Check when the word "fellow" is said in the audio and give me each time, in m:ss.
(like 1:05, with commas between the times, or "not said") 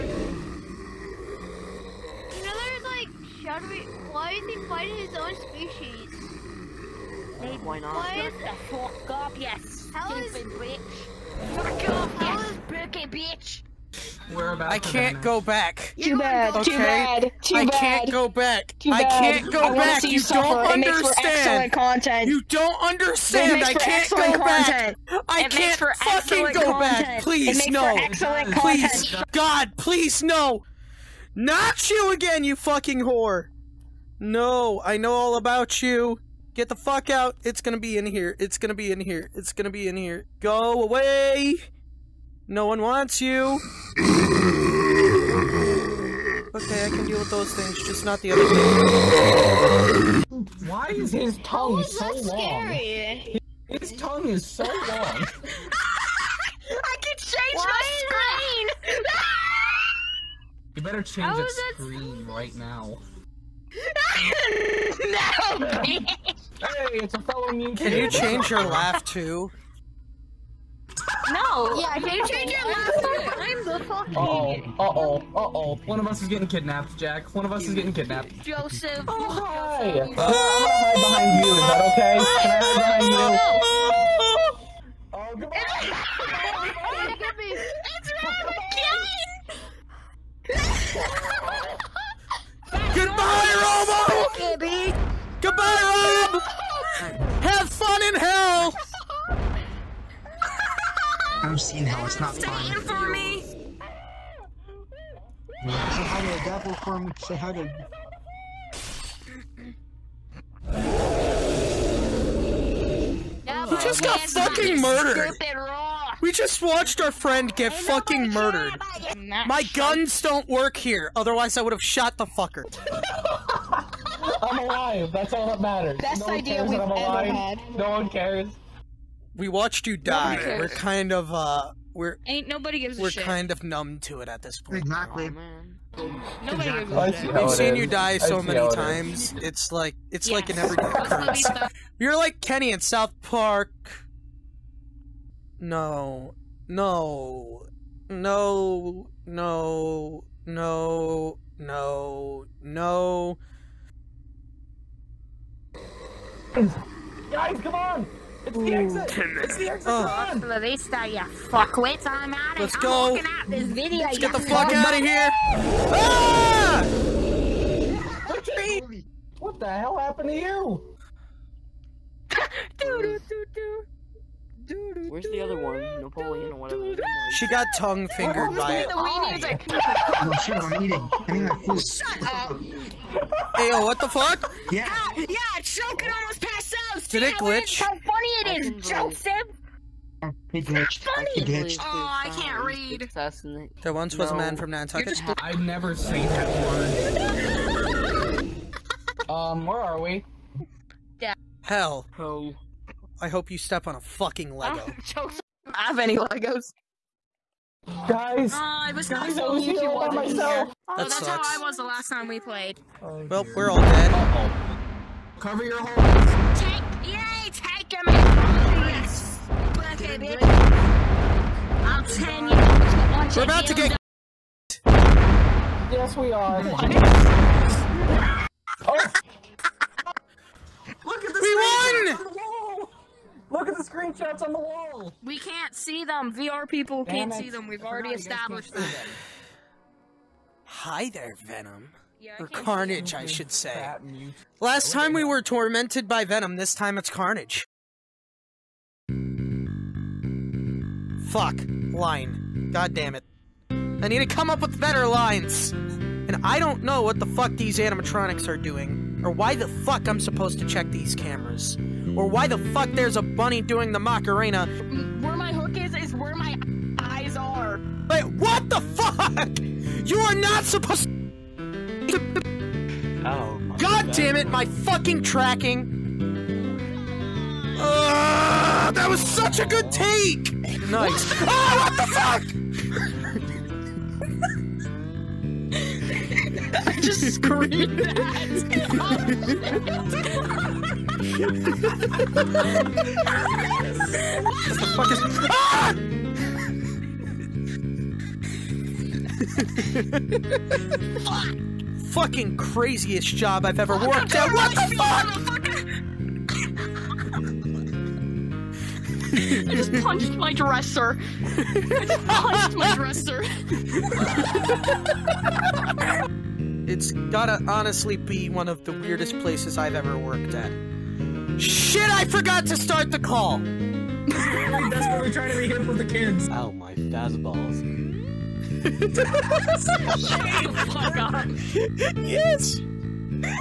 1:07.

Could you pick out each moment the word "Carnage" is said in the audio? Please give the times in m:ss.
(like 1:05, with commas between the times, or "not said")
4:02, 4:07.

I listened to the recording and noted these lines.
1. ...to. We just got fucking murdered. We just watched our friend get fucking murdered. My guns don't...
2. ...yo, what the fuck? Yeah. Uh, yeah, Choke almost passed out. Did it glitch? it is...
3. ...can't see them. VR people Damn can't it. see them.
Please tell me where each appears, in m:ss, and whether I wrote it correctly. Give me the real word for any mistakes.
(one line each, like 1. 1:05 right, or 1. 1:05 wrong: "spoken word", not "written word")
1. 1:47 right
2. 3:03 right
3. 3:55 right.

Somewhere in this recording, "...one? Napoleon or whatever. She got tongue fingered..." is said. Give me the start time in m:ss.
2:55.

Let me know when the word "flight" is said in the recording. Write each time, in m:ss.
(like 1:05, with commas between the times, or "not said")
not said.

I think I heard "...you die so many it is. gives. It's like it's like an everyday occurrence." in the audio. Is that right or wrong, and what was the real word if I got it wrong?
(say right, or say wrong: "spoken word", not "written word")
wrong: "times", not "gives".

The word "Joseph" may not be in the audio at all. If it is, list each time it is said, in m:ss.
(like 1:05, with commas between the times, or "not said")
1:18, 3:08.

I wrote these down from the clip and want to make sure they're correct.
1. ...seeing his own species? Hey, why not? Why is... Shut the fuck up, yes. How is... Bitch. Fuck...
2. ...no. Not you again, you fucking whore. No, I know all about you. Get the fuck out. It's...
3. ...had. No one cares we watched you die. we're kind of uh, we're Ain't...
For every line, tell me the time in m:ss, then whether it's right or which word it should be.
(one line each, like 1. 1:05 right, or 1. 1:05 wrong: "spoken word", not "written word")
1. 0:04 wrong: "fighting", not "seeing"
2. 0:30 right
3. 2:06 right.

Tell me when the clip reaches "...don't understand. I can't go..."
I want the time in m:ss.
0:22.